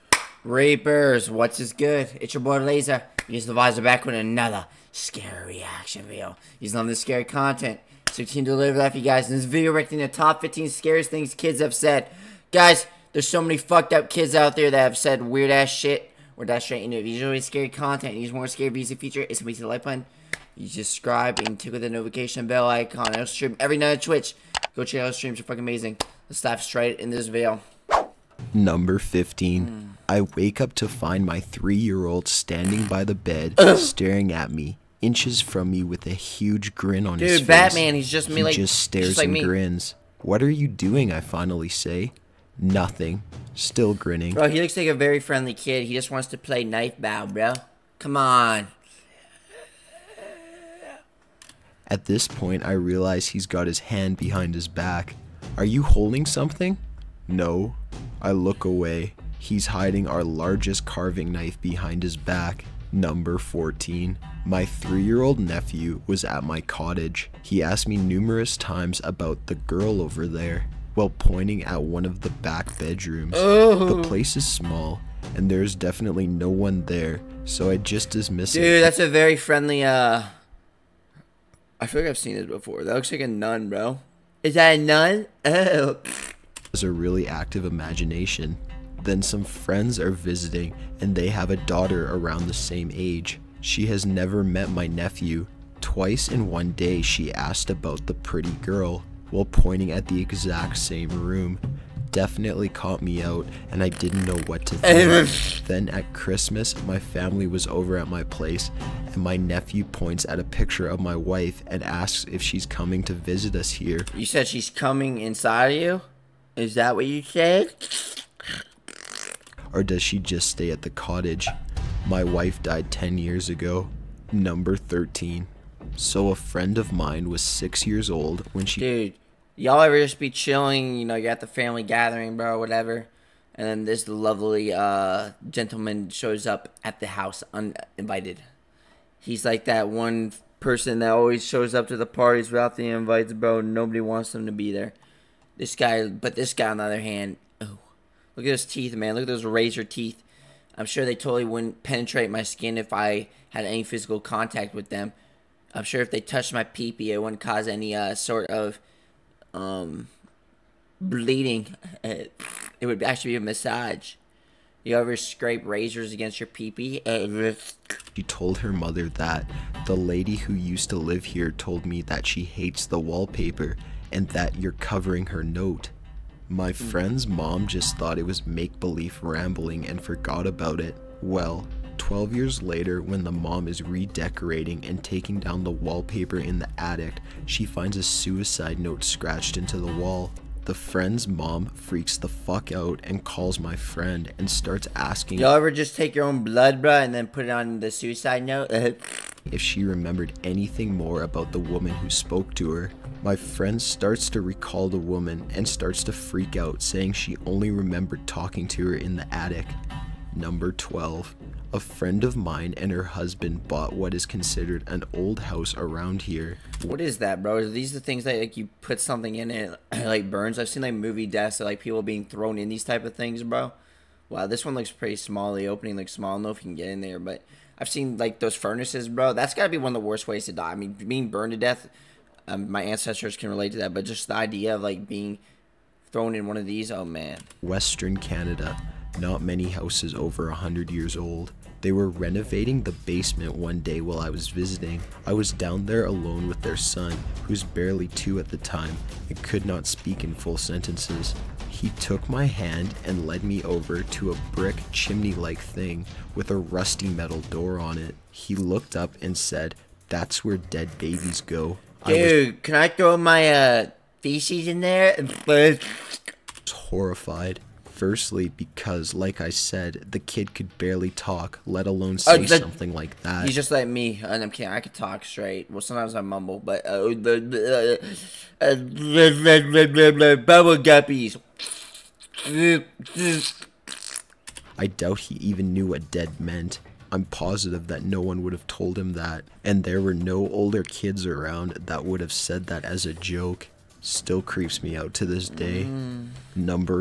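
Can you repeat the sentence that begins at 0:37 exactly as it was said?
Dude, Batman, he's just me he like, just stares just like and me.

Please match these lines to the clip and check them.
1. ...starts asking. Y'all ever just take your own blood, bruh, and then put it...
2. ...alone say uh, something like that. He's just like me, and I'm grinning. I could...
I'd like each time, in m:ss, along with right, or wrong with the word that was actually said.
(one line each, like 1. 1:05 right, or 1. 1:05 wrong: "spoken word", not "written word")
1. 3:14 right
2. 4:31 wrong: "kidding", not "grinning".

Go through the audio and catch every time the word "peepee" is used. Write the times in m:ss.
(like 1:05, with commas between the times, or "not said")
2:36, 2:46.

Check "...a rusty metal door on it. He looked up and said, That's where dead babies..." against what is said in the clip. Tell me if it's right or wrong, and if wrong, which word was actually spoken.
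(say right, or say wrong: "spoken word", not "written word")
right.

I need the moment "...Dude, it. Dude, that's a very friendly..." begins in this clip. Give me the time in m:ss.
1:18.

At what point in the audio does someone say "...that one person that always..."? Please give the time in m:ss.
2:19.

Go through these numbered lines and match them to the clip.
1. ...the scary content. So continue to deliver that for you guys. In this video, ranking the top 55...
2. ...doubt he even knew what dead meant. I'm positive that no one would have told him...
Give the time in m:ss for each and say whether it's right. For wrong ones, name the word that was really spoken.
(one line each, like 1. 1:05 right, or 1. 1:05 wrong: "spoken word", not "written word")
1. 0:06 wrong: "15", not "55"
2. 4:44 right.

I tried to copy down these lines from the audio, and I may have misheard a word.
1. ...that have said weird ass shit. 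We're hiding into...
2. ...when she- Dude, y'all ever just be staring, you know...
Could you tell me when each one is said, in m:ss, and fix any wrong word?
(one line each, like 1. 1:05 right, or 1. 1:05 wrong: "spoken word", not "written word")
1. 0:14 wrong: "dashing", not "hiding"
2. 2:08 wrong: "chilling", not "staring".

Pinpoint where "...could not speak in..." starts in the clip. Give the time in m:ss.
4:09.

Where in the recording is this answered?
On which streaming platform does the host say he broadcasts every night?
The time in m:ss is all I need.
0:23.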